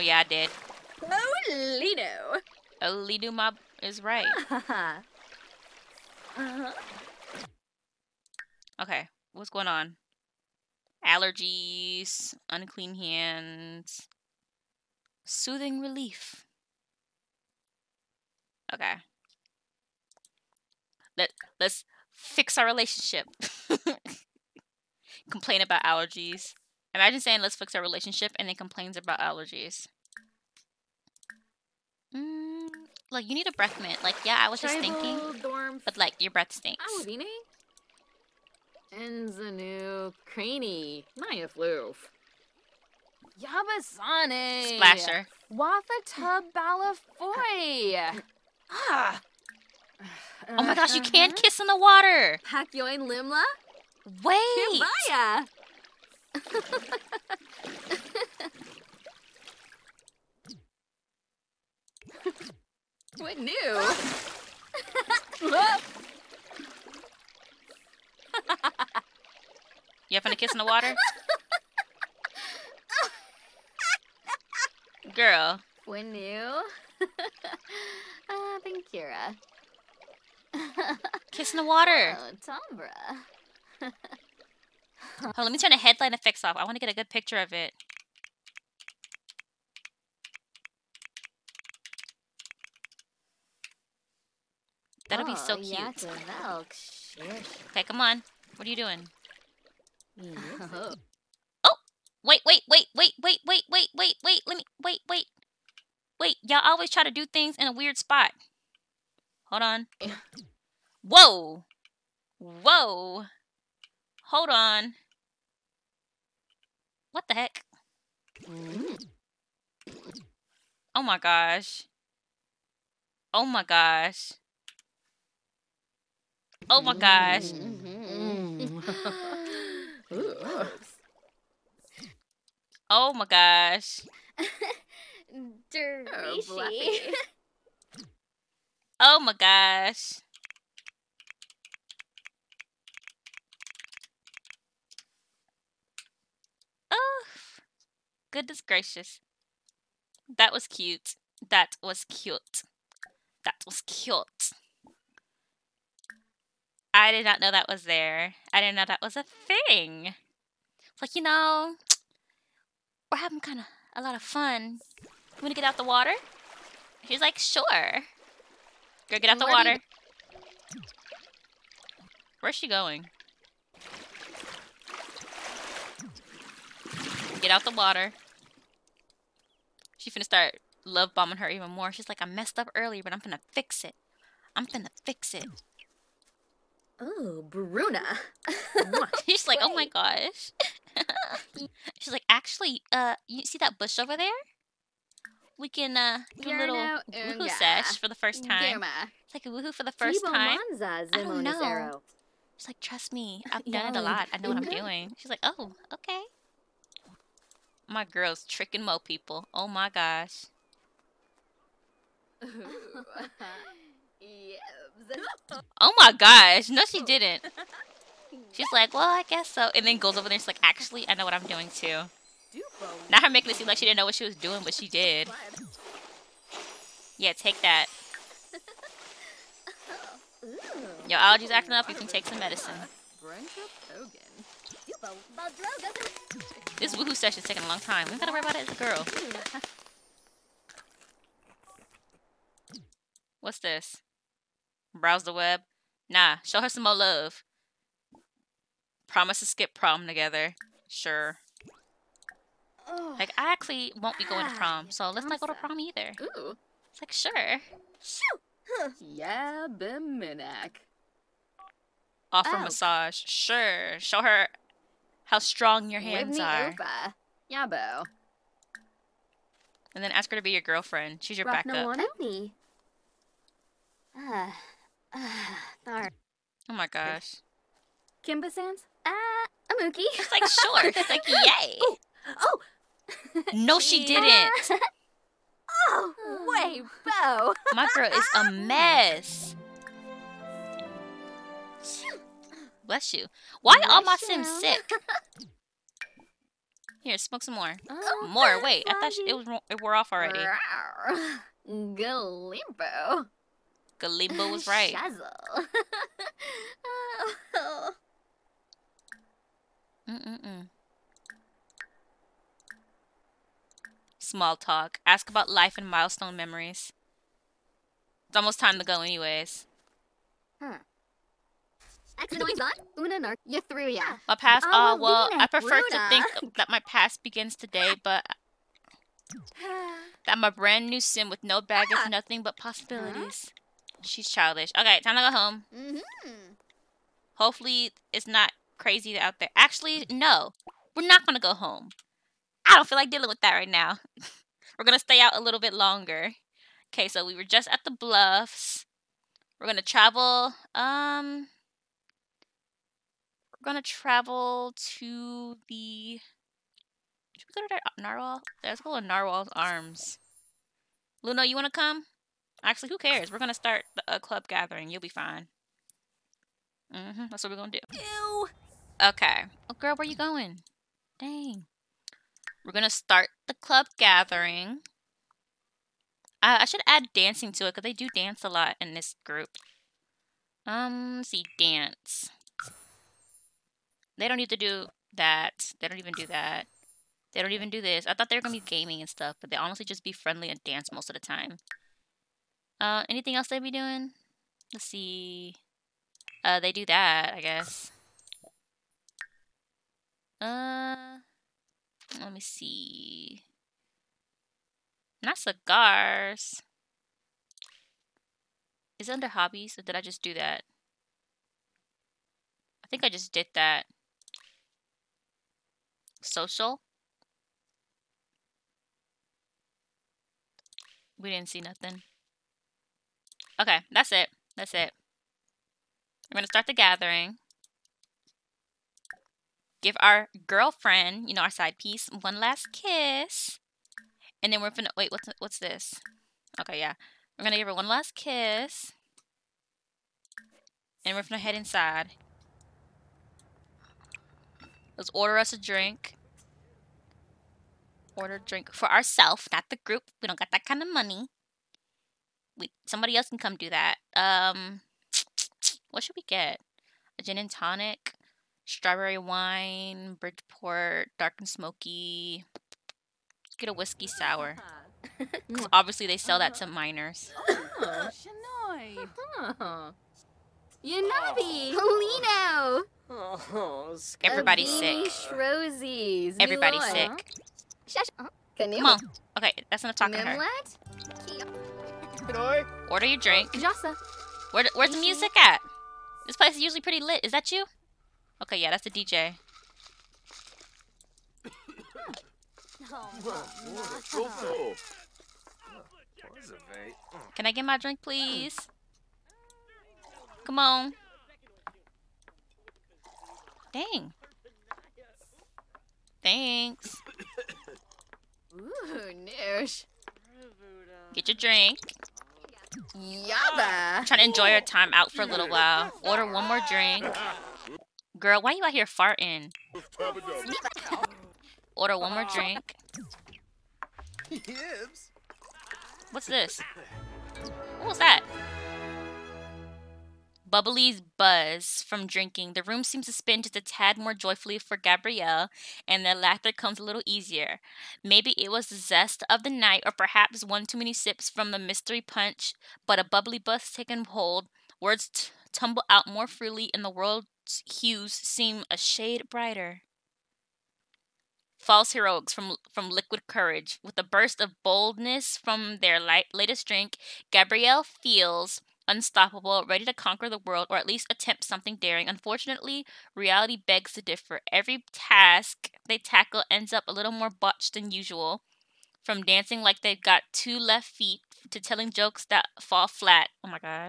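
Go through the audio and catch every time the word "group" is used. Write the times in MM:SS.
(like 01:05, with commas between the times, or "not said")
06:19, 07:29.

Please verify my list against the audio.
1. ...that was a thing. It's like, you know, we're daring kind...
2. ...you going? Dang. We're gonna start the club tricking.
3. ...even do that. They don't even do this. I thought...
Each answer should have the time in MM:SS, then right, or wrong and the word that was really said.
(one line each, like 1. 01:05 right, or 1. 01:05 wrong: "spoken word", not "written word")
1. 02:38 wrong: "having", not "daring"
2. 06:10 wrong: "gathering", not "tricking"
3. 06:25 right.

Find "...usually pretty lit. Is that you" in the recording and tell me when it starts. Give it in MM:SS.
08:06.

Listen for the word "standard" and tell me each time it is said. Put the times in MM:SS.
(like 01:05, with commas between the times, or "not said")
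not said.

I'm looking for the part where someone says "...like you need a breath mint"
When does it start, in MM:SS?
00:33.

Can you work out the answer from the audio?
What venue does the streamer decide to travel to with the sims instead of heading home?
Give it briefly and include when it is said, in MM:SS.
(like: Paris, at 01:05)
Narwhal's Arms, at 05:59.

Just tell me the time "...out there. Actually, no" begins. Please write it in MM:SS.
05:39.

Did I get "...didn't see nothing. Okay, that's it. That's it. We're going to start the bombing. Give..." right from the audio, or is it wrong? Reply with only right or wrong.
wrong.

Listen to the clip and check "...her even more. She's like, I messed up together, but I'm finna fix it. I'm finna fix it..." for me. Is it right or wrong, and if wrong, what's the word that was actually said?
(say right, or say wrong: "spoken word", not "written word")
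wrong: "earlier", not "together".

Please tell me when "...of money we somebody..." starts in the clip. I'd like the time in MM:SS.
07:30.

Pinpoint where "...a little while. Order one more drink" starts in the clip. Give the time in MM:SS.
08:35.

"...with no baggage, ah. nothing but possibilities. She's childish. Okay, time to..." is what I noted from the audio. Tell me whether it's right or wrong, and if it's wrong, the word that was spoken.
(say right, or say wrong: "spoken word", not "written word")
right.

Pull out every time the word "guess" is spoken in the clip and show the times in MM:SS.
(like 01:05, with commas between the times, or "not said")
03:39, 06:37.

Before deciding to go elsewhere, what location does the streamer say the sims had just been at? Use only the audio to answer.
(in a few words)
The Bluffs.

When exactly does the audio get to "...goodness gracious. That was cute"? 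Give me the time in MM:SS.
02:28.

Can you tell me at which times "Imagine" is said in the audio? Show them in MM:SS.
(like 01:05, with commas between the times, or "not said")
00:26.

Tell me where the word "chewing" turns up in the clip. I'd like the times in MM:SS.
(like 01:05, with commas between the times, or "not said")
not said.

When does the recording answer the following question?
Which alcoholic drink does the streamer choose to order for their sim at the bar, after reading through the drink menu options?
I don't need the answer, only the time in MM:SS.
07:43.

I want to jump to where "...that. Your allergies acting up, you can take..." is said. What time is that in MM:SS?
03:47.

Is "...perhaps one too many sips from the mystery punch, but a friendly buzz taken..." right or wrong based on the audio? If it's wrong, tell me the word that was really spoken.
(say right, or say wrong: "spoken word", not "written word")
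wrong: "bubbly", not "friendly".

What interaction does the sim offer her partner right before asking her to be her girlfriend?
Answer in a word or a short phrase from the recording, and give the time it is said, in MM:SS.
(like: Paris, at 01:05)
Massage, at 04:22.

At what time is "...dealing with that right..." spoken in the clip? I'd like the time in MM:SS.
05:43.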